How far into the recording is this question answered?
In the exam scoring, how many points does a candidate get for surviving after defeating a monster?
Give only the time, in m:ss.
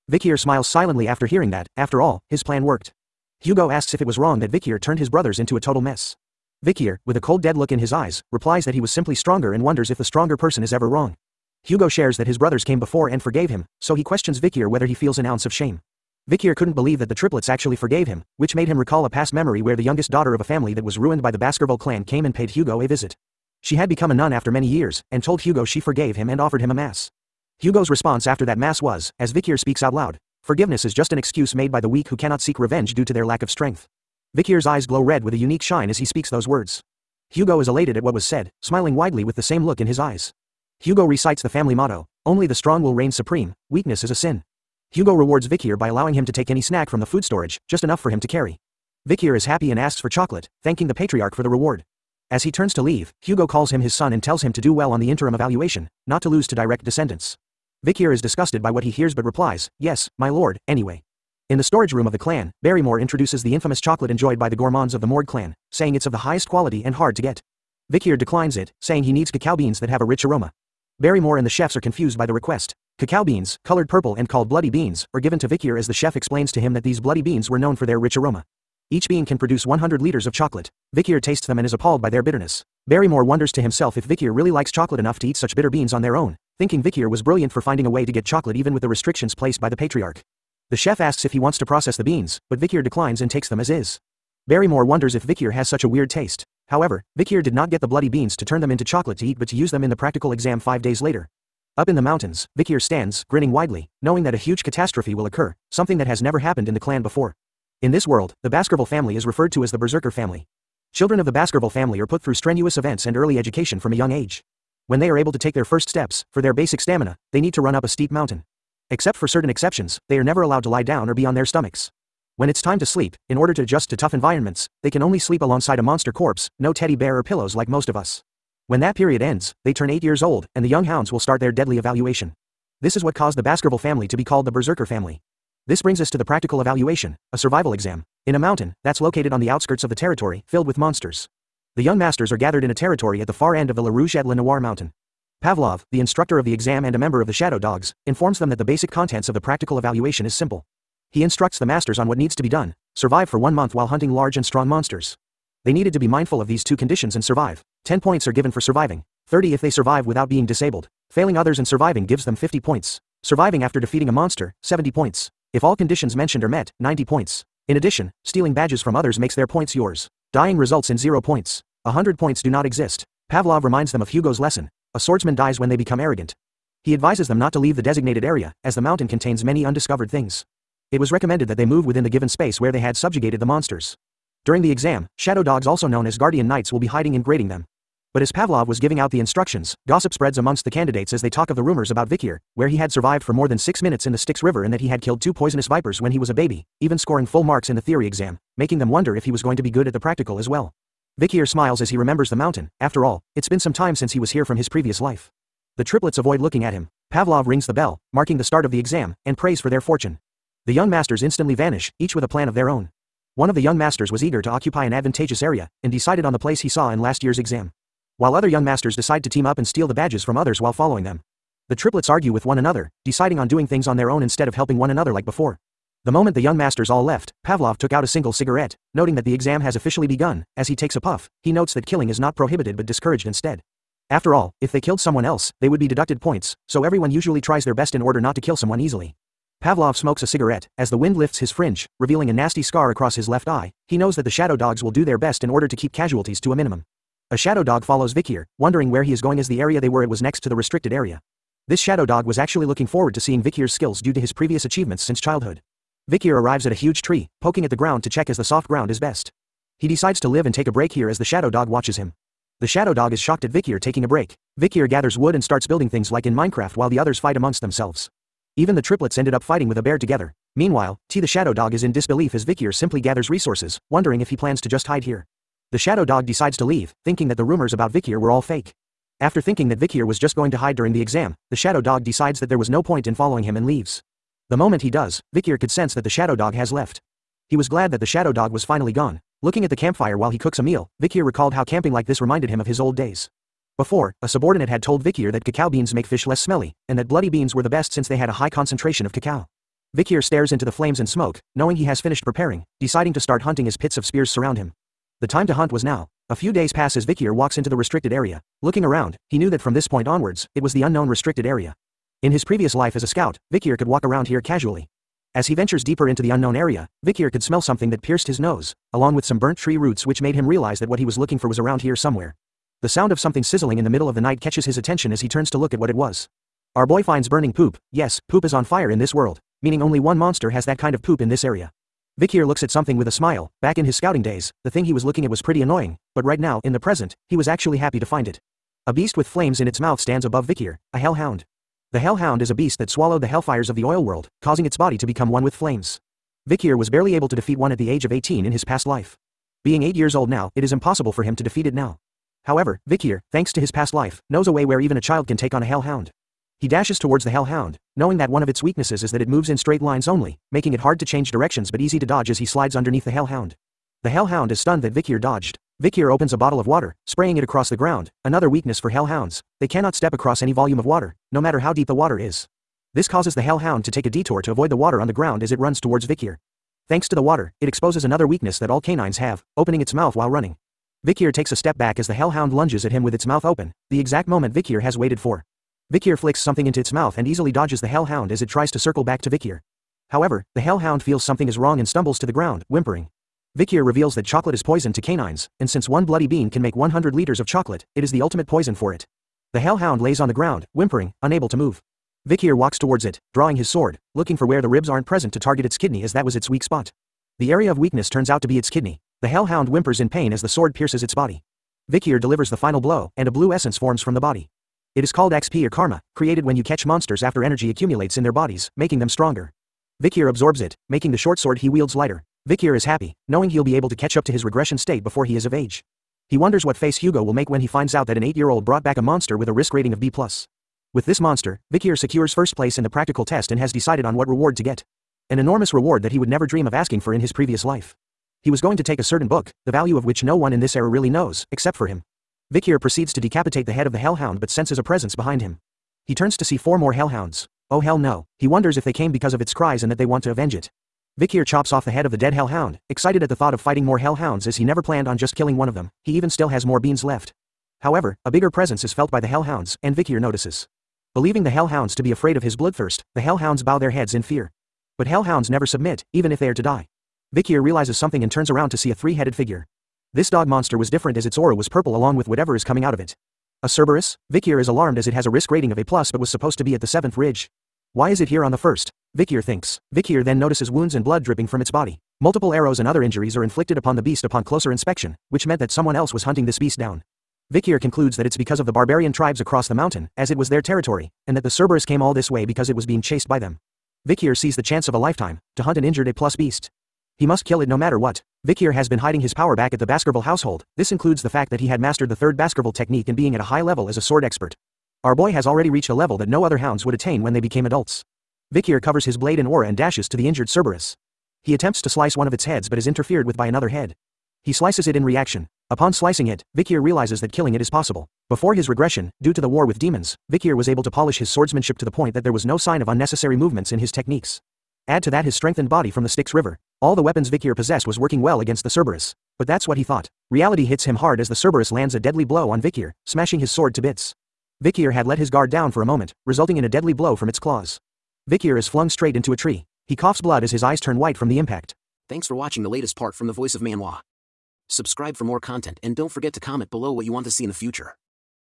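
2:44.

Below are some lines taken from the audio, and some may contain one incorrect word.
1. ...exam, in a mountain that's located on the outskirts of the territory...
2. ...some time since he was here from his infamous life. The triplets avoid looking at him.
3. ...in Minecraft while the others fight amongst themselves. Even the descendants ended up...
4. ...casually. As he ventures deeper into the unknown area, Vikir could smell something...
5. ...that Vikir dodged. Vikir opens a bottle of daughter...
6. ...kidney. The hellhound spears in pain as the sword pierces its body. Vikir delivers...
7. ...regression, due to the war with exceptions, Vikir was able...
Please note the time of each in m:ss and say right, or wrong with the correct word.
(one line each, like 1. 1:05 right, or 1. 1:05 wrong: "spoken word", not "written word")
1. 2:17 right
2. 3:23 wrong: "previous", not "infamous"
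3. 4:26 wrong: "triplets", not "descendants"
4. 5:14 right
5. 6:04 wrong: "water", not "daughter"
6. 6:48 wrong: "whimpers", not "spears"
7. 8:38 wrong: "demons", not "exceptions".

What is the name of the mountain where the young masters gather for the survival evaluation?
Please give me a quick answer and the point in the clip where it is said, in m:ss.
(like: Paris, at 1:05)
La Rouge et Le Noir, at 2:23.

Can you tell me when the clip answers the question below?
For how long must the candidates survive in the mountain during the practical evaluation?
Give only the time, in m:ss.
2:33.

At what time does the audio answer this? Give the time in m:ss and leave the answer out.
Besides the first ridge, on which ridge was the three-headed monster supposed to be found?
7:56.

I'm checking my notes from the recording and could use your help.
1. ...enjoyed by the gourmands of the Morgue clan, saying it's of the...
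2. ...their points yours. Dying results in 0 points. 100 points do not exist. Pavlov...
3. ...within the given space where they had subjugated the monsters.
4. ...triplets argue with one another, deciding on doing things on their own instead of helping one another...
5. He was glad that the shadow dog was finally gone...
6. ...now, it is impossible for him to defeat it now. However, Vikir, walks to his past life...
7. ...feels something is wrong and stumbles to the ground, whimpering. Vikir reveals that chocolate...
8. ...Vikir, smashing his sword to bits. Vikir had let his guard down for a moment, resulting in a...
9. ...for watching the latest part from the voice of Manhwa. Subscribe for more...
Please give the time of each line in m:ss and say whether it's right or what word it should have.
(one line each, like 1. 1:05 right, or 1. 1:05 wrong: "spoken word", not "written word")
1. 1:04 right
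2. 2:49 right
3. 3:01 right
4. 3:41 right
5. 4:47 right
6. 5:50 wrong: "thanks", not "walks"
7. 6:31 right
8. 8:52 right
9. 9:02 right.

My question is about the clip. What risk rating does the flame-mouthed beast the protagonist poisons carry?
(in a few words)
B+.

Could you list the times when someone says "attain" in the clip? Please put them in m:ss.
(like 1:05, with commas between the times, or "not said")
8:26.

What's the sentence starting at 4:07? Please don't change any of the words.
A shadow dog follows Vikir, wondering where he is going as the area they were at was next to the restricted area.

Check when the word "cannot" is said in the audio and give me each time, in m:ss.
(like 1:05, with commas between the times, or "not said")
0:32, 6:09.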